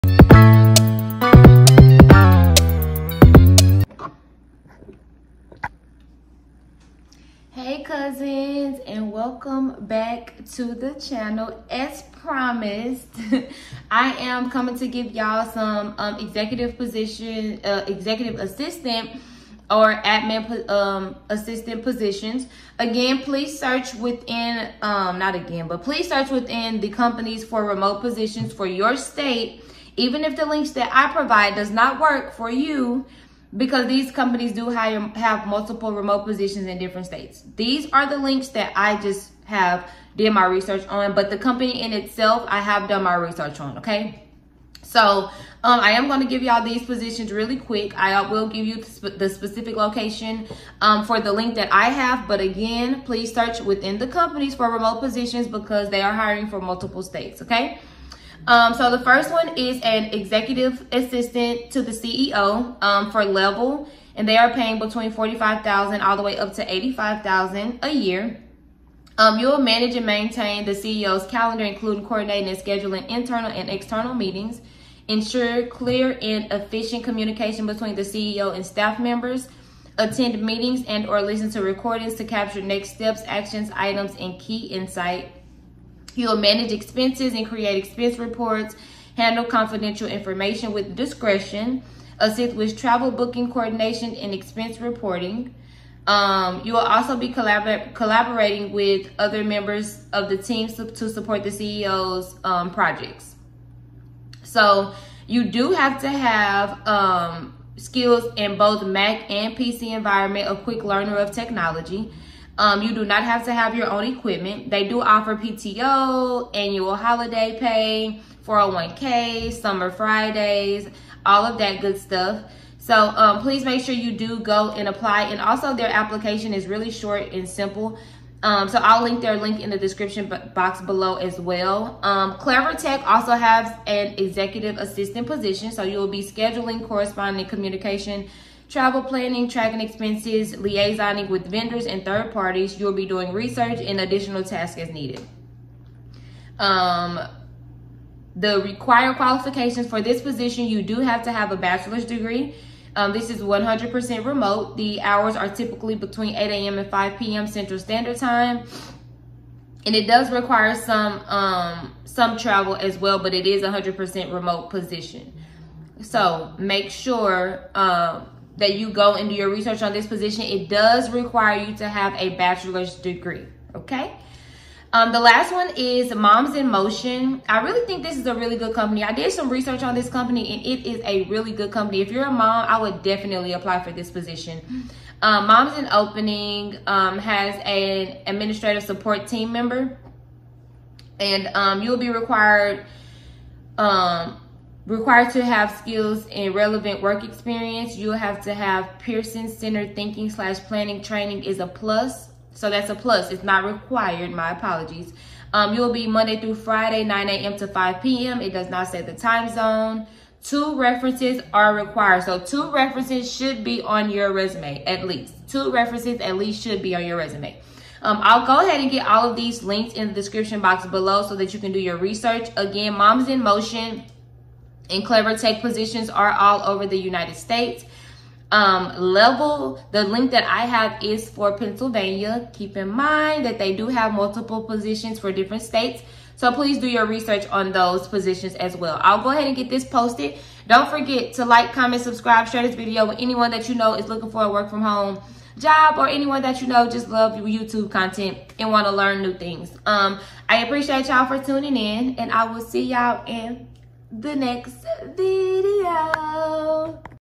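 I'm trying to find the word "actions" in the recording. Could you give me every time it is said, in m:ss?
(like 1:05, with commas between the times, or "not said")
1:23.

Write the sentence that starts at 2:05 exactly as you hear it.
And also their application is really short and simple.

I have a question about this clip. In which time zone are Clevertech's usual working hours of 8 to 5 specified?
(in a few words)
Central Standard Time.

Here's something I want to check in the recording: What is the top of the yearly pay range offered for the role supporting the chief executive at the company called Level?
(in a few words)
$85,000.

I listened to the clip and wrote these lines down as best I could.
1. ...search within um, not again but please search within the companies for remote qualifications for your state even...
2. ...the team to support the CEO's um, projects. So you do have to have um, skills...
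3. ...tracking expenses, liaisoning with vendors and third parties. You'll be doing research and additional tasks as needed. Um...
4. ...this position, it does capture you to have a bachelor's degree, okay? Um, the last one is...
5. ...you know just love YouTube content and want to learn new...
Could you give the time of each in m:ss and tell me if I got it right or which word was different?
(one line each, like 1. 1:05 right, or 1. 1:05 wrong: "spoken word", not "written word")
1. 0:23 wrong: "positions", not "qualifications"
2. 1:40 right
3. 2:19 right
4. 2:49 wrong: "require", not "capture"
5. 4:06 right.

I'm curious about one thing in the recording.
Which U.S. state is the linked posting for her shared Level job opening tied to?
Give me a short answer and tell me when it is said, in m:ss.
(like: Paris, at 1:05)
Pennsylvania, at 3:51.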